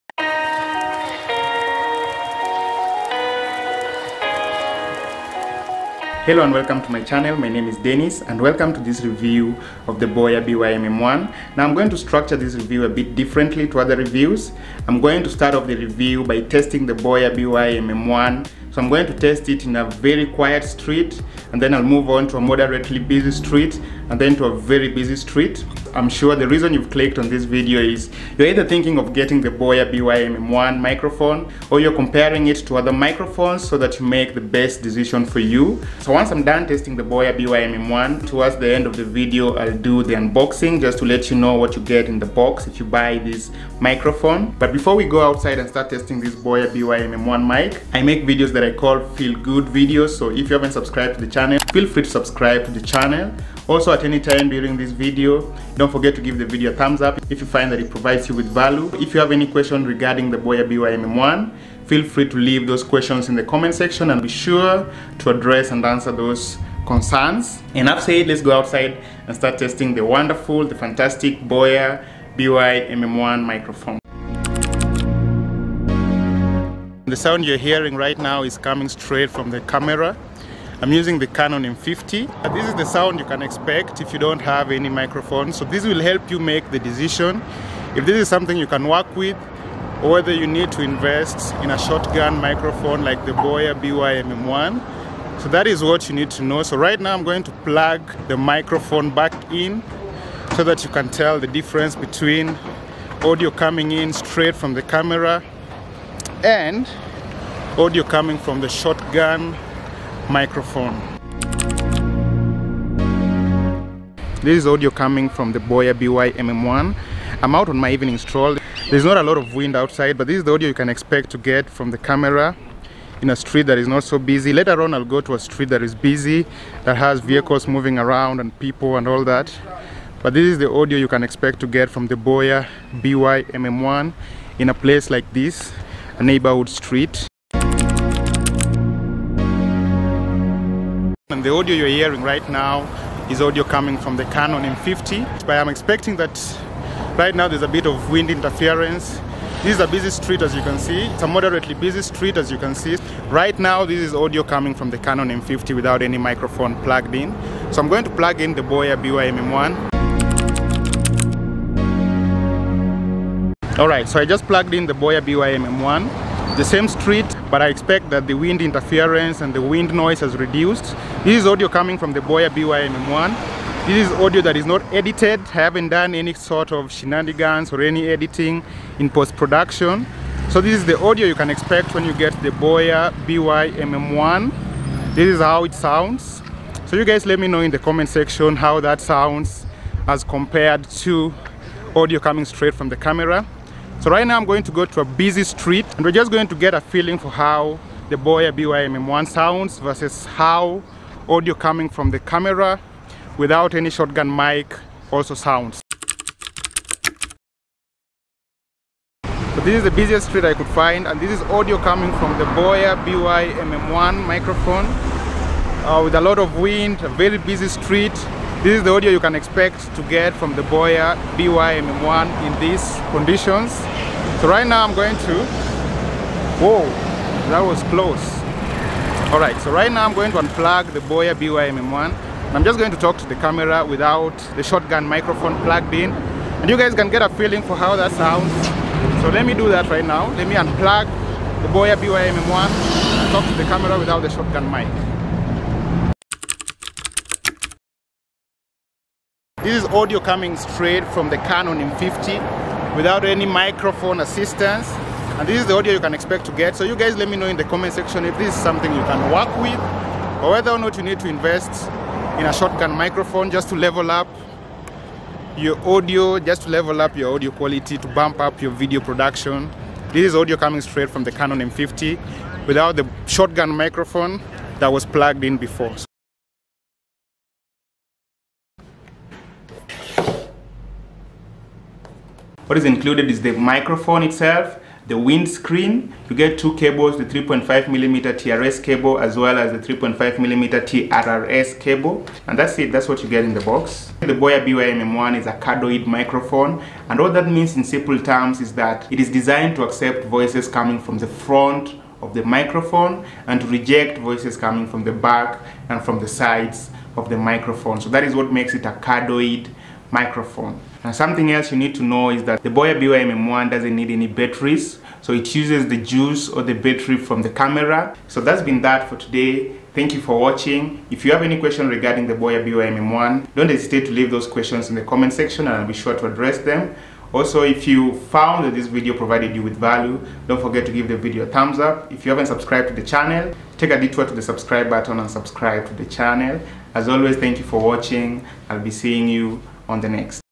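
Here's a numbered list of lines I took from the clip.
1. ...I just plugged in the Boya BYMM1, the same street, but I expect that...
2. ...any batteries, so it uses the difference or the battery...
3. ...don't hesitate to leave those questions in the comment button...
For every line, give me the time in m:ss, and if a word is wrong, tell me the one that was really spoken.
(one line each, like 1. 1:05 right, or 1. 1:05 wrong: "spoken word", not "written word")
1. 2:44 right
2. 5:14 wrong: "juice", not "difference"
3. 5:23 wrong: "section", not "button".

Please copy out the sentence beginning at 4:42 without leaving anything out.
What is included is the microphone itself, the windscreen.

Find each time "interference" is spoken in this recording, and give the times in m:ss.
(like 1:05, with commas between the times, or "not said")
2:28, 2:48.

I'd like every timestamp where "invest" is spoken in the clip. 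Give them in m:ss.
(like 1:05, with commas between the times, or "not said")
1:30, 4:21.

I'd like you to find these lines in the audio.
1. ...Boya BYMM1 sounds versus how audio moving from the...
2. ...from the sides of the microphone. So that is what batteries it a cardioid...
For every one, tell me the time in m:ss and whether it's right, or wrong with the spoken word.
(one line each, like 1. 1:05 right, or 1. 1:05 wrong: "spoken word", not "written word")
1. 3:18 wrong: "coming", not "moving"
2. 5:06 wrong: "makes", not "batteries".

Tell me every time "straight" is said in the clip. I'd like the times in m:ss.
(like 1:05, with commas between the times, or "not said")
1:18, 1:44, 3:12, 4:10, 4:30.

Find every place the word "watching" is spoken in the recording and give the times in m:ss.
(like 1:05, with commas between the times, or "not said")
5:20, 5:37.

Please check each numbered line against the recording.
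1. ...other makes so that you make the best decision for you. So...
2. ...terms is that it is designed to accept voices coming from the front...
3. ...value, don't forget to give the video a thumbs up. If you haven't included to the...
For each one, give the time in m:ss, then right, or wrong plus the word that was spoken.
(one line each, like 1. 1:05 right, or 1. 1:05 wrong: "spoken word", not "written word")
1. 0:32 wrong: "microphones", not "makes"
2. 4:58 right
3. 5:29 wrong: "subscribed", not "included".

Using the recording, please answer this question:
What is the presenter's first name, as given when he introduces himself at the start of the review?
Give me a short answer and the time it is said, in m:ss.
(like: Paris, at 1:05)
Dennis, at 0:07.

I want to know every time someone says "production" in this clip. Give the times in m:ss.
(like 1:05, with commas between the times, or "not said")
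2:59, 4:28.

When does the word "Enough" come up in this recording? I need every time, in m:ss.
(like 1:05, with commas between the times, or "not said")
1:07.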